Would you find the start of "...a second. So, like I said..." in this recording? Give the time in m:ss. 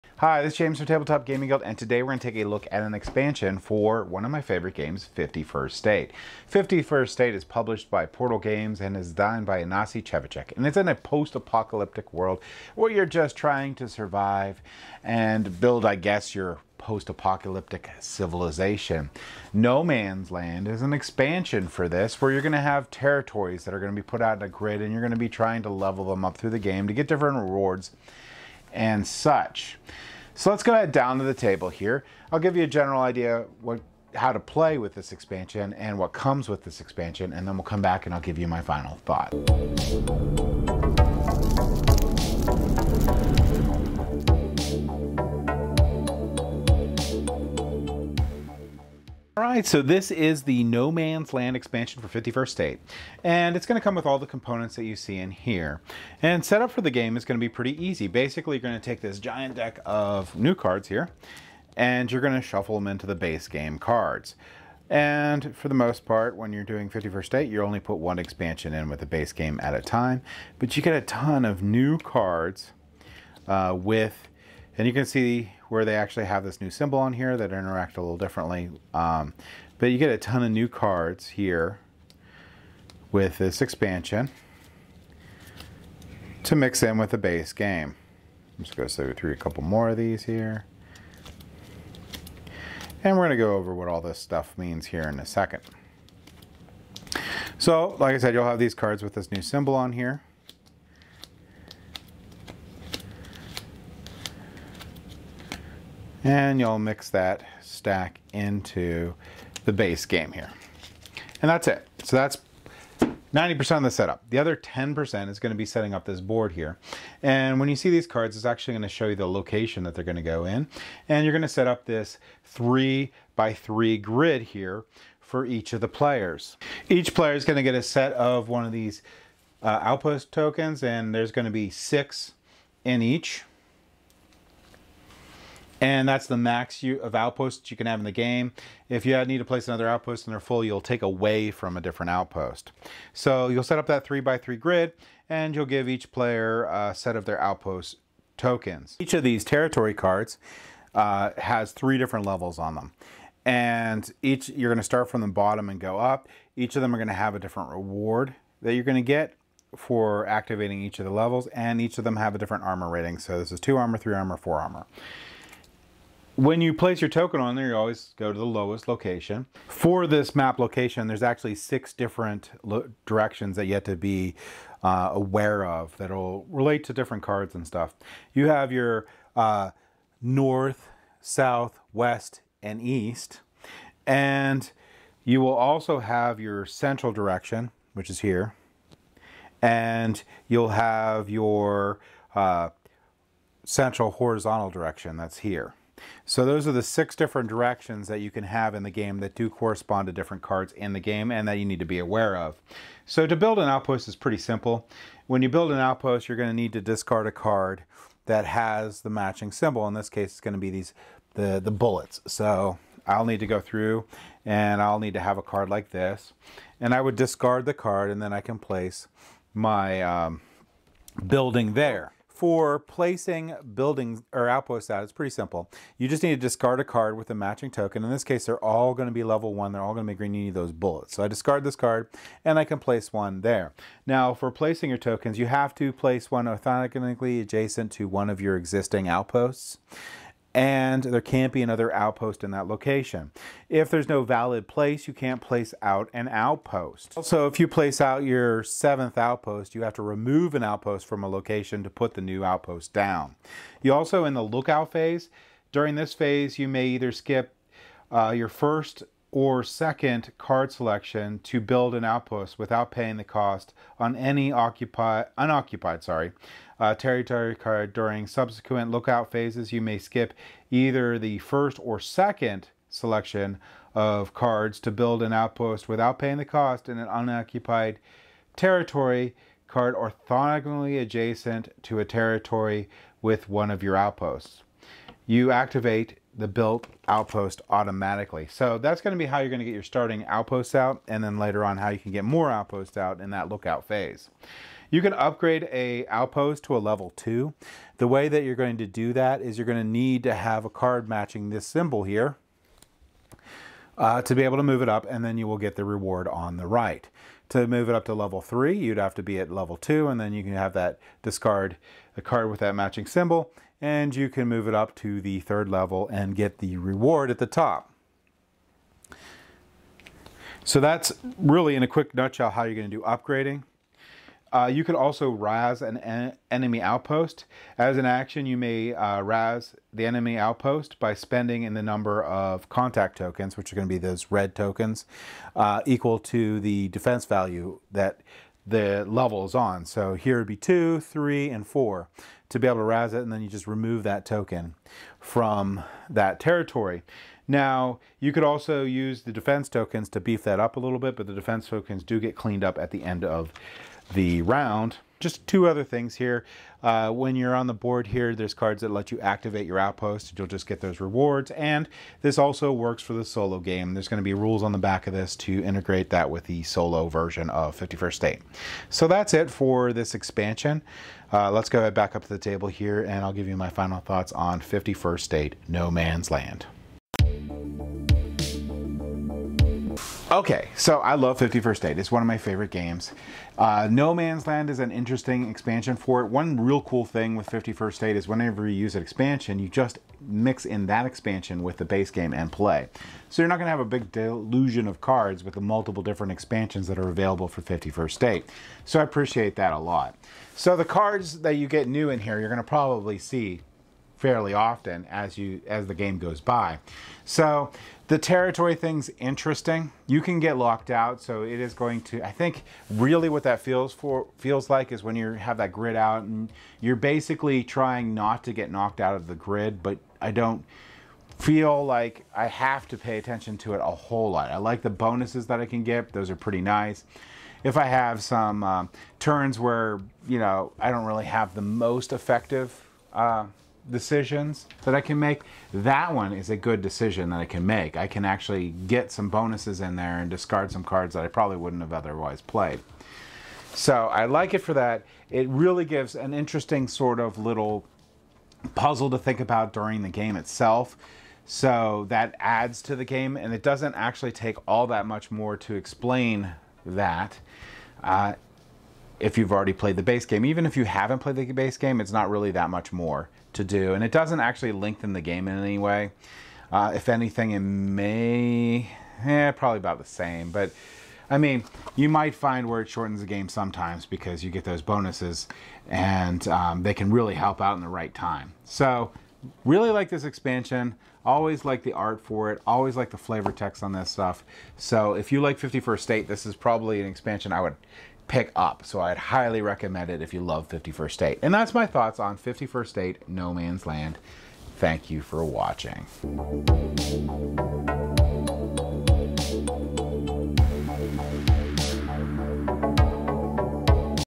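1:35.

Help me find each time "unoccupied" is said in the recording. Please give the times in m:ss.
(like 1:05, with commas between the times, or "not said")
4:25, 4:37.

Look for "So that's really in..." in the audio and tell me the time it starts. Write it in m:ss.
5:20.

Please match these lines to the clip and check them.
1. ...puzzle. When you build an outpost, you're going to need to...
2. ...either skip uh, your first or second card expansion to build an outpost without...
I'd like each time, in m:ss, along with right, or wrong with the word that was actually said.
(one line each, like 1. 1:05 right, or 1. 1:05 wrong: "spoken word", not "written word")
1. 3:24 wrong: "simple", not "puzzle"
2. 4:16 wrong: "selection", not "expansion".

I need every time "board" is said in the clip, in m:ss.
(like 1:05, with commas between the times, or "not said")
1:56, 5:57.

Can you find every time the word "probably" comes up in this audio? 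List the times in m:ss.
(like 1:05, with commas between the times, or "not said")
6:42, 7:21, 7:49, 8:06.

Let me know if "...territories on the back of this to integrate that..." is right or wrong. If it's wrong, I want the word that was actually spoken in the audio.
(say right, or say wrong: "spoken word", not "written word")
wrong: "rules", not "territories".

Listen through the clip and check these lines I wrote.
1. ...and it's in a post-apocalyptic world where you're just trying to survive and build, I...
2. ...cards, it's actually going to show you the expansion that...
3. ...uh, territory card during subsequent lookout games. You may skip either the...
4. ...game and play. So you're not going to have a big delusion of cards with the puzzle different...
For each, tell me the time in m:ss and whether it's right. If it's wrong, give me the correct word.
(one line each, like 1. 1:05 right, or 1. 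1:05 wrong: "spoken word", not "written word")
1. 0:10 right
2. 1:58 wrong: "location", not "expansion"
3. 4:26 wrong: "phases", not "games"
4. 6:32 wrong: "multiple", not "puzzle".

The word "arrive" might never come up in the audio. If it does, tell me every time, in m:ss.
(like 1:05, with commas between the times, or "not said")
not said.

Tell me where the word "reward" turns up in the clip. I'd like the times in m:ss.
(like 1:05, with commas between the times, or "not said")
0:27, 2:37, 5:05, 5:16, 6:00.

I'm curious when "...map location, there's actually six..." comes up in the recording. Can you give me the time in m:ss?
2:50.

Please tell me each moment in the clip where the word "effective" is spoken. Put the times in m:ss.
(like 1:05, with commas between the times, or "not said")
7:12.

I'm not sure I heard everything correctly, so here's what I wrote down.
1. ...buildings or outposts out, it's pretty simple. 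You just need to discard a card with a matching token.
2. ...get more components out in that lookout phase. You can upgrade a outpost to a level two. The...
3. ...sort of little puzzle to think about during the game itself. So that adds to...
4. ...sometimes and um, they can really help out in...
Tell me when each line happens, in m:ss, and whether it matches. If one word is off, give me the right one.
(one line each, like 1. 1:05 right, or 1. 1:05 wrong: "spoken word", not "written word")
1. 3:43 right
2. 4:52 wrong: "outposts", not "components"
3. 7:26 right
4. 7:54 wrong: "bonuses", not "sometimes".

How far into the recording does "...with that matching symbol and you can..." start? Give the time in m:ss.
5:12.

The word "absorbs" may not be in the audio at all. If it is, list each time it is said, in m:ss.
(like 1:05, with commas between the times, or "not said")
not said.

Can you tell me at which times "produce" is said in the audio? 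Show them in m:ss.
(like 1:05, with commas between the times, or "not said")
not said.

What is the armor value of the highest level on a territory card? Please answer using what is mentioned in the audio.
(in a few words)
4.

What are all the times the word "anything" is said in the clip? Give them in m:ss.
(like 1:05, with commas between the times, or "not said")
7:47.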